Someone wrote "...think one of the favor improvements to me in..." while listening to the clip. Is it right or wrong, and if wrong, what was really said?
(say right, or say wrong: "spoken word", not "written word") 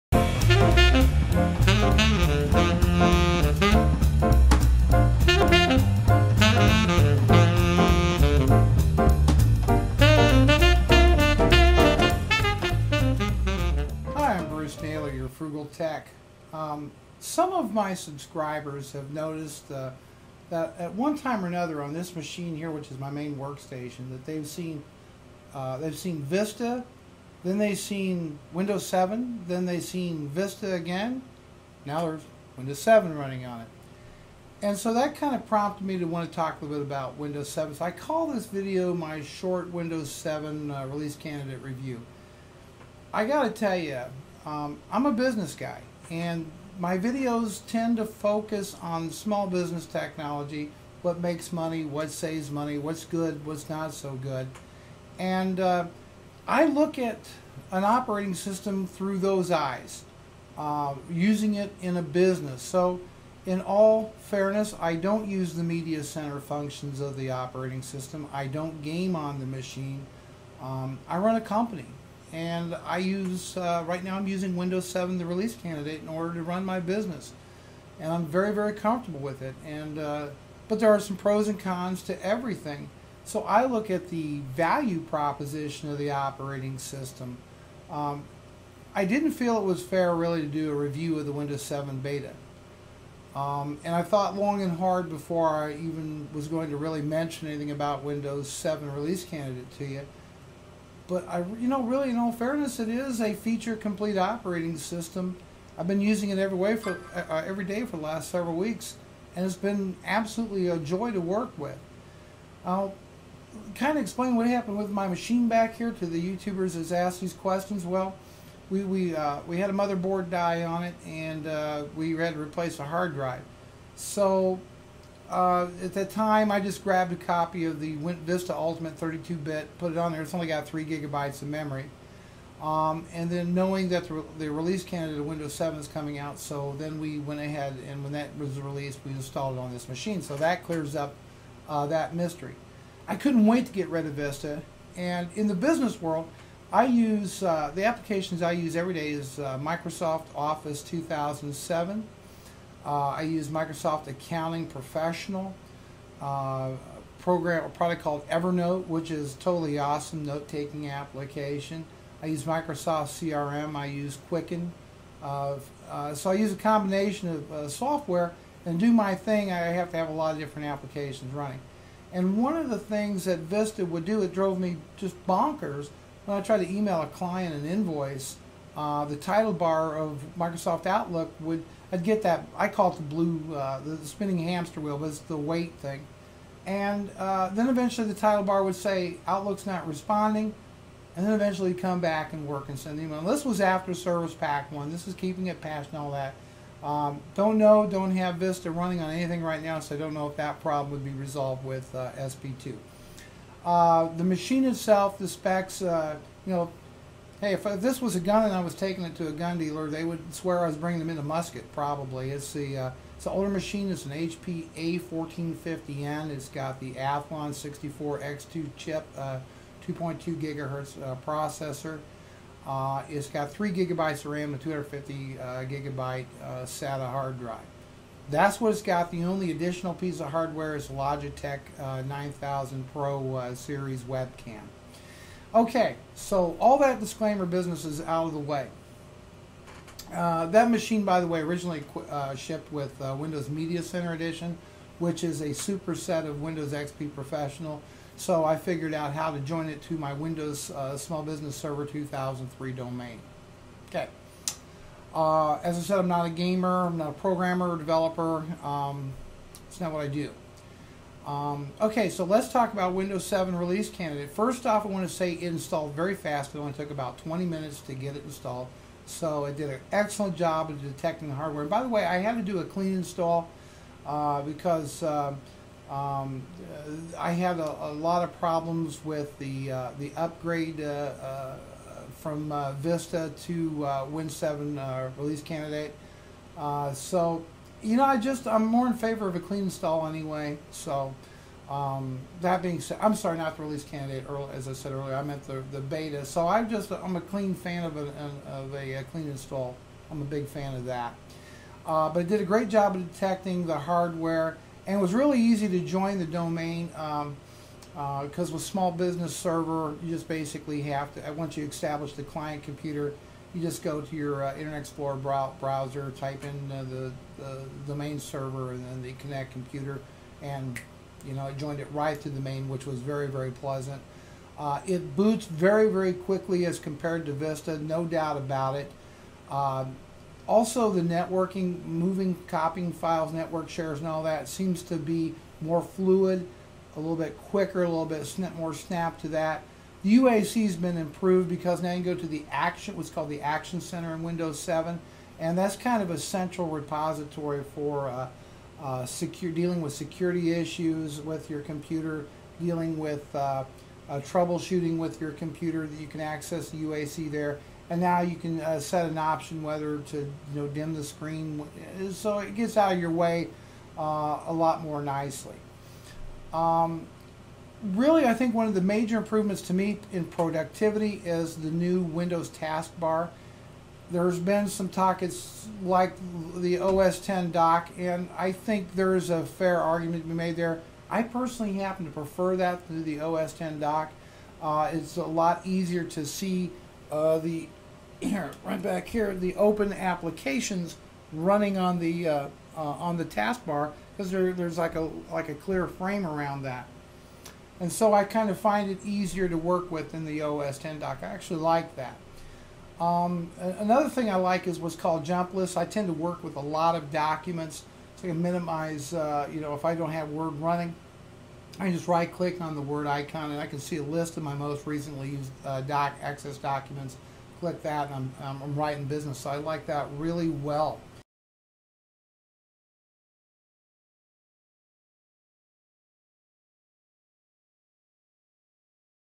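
wrong: "major", not "favor".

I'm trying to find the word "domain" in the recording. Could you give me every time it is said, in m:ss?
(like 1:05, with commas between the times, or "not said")
4:12, 5:06.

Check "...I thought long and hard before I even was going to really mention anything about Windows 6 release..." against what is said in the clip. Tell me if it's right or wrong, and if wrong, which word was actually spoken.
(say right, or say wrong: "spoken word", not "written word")
wrong: "7", not "6".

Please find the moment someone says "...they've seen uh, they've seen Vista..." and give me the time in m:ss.
0:24.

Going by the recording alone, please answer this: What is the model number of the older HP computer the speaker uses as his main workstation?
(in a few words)
A1450N.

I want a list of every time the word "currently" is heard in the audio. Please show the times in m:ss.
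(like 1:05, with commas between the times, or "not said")
not said.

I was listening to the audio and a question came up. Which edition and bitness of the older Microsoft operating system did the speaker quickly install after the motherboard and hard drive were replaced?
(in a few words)
Vista Ultimate 32-bit.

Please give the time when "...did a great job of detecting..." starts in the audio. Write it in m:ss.
5:02.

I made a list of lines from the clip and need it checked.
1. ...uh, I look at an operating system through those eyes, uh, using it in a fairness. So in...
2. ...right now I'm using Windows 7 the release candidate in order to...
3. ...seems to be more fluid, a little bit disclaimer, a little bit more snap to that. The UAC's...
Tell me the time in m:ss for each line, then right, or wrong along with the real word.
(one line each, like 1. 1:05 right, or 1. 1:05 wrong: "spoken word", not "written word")
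1. 0:55 wrong: "business", not "fairness"
2. 1:13 right
3. 5:34 wrong: "quicker", not "disclaimer".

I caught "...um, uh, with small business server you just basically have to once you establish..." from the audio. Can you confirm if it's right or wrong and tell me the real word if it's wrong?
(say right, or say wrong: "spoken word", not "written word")
right.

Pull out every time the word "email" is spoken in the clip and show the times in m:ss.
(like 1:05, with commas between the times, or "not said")
2:56, 3:13.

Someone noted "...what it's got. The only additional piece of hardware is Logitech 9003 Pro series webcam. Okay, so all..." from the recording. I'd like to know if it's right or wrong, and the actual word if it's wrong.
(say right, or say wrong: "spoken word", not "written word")
wrong: "9000", not "9003".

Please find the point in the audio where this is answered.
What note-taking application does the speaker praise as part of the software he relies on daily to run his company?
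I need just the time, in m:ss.
2:38.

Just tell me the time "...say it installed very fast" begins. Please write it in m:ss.
4:25.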